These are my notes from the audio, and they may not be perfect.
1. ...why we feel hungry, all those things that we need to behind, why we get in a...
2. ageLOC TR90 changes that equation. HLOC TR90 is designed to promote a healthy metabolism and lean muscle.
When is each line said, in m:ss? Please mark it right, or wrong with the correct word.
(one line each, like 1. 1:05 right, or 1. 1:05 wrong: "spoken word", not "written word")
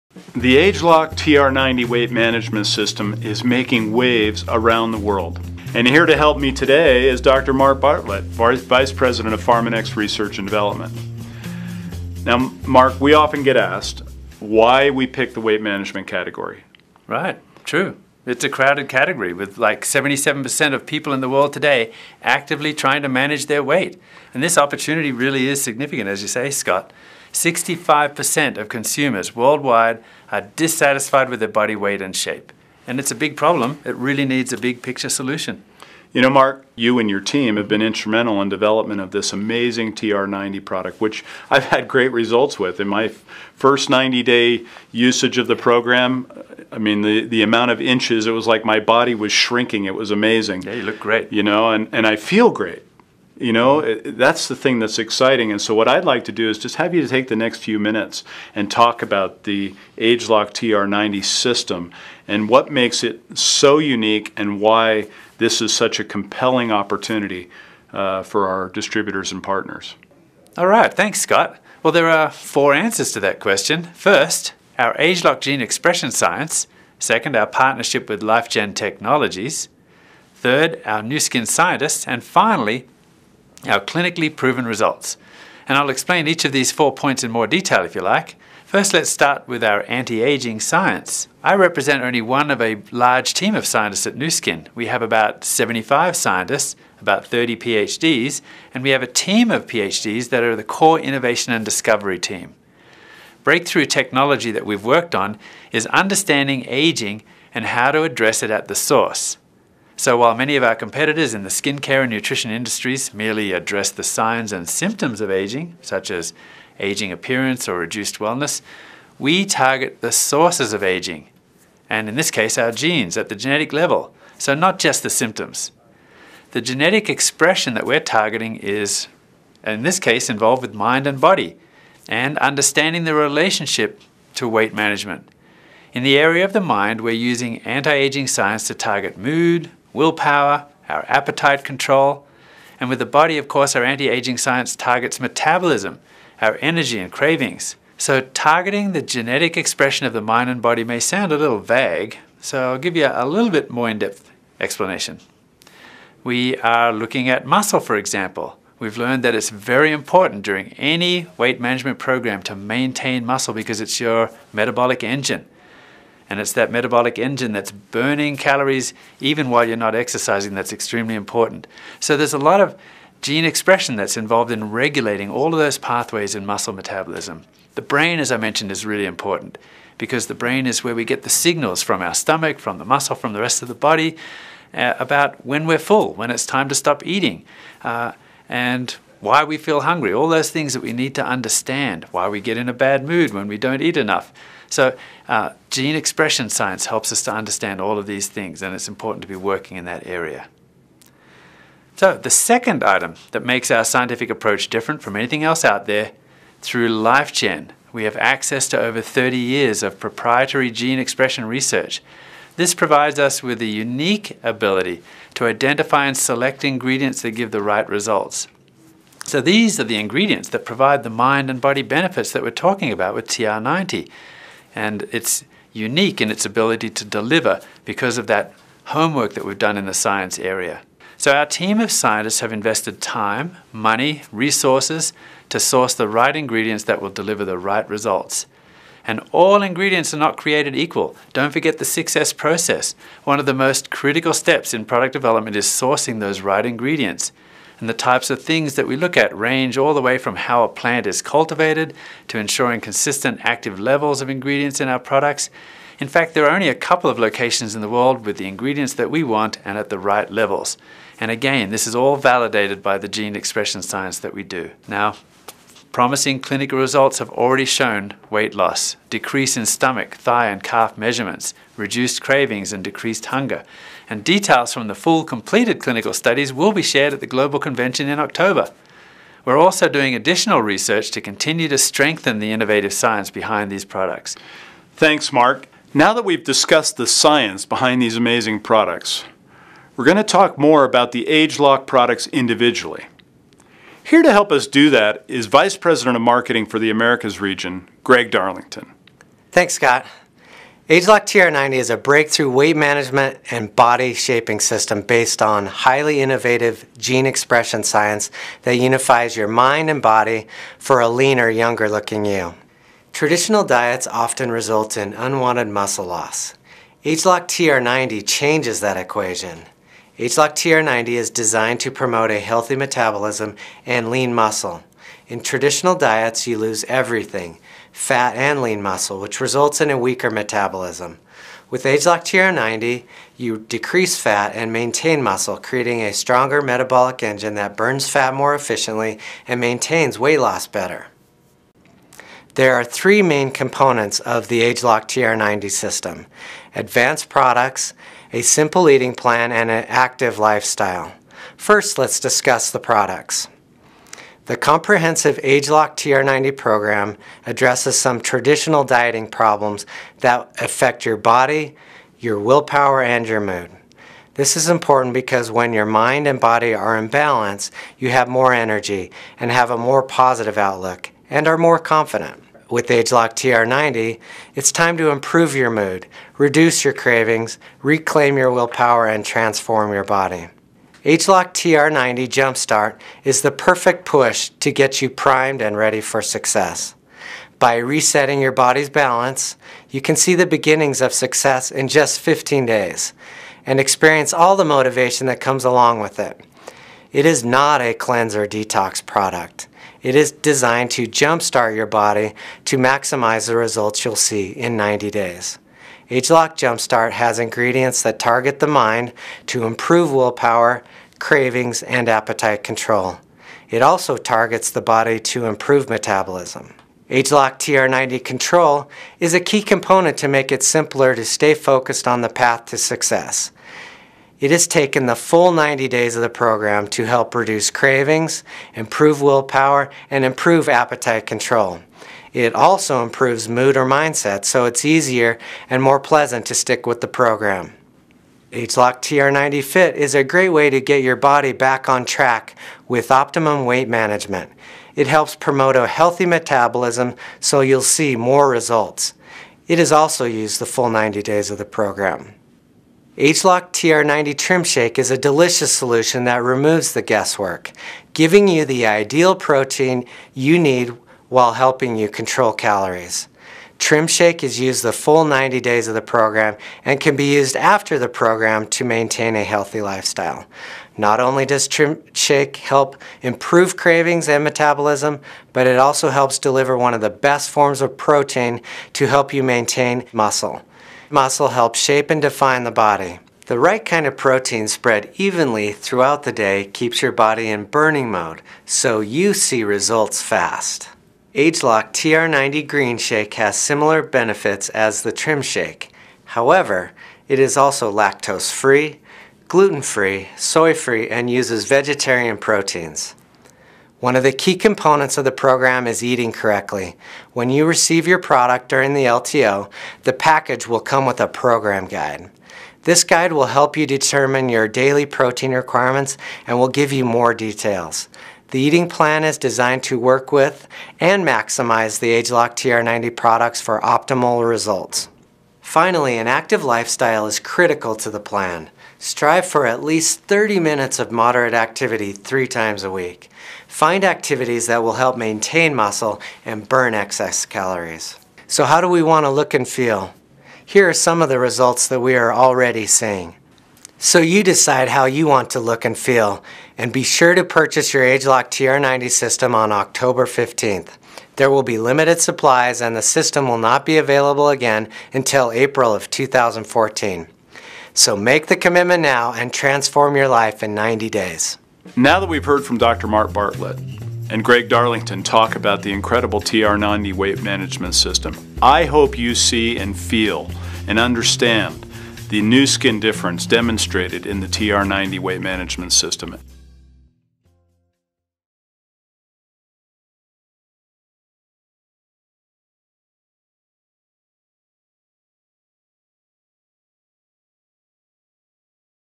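1. 3:09 wrong: "understand", not "behind"
2. 5:17 right.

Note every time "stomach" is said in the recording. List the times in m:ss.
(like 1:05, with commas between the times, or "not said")
3:02, 4:29.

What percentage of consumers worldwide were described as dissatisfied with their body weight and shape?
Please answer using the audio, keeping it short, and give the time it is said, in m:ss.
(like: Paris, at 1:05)
65%, at 0:27.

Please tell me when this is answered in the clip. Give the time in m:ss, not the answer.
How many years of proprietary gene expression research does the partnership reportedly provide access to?
3:29.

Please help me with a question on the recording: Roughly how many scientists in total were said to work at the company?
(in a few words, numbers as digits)
75.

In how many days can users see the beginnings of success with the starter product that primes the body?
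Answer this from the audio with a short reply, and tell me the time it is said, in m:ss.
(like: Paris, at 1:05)
15, at 6:32.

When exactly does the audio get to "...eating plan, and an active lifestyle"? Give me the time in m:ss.
5:48.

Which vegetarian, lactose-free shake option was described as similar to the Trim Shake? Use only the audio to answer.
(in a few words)
Green Shake.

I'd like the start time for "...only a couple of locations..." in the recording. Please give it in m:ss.
4:16.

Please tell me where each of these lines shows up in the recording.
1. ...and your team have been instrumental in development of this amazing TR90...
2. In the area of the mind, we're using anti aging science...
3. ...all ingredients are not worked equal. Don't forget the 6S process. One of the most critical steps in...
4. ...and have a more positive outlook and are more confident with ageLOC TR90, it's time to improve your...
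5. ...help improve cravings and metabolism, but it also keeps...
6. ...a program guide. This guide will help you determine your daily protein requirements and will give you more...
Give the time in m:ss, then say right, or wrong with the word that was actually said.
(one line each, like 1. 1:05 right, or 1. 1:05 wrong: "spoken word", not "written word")
1. 0:36 right
2. 2:15 right
3. 3:59 wrong: "created", not "worked"
4. 6:09 right
5. 7:52 wrong: "helps", not "keeps"
6. 8:31 right.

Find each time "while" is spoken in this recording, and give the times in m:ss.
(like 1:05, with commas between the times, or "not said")
1:50, 2:49, 7:41.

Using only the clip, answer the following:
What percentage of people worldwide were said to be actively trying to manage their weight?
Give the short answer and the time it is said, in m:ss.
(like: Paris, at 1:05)
77%, at 0:19.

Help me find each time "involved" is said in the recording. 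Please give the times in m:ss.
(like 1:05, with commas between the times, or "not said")
2:10, 2:54.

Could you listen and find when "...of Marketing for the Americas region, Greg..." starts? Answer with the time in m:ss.
4:56.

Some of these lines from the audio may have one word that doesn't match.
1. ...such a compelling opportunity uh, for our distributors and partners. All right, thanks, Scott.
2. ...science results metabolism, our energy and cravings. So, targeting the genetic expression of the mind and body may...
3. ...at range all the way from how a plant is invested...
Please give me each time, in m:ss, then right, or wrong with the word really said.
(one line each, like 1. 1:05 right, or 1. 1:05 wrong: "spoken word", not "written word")
1. 1:05 right
2. 2:24 wrong: "targets", not "results"
3. 4:09 wrong: "cultivated", not "invested".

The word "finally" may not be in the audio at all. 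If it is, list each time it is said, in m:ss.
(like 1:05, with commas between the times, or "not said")
1:22, 8:45.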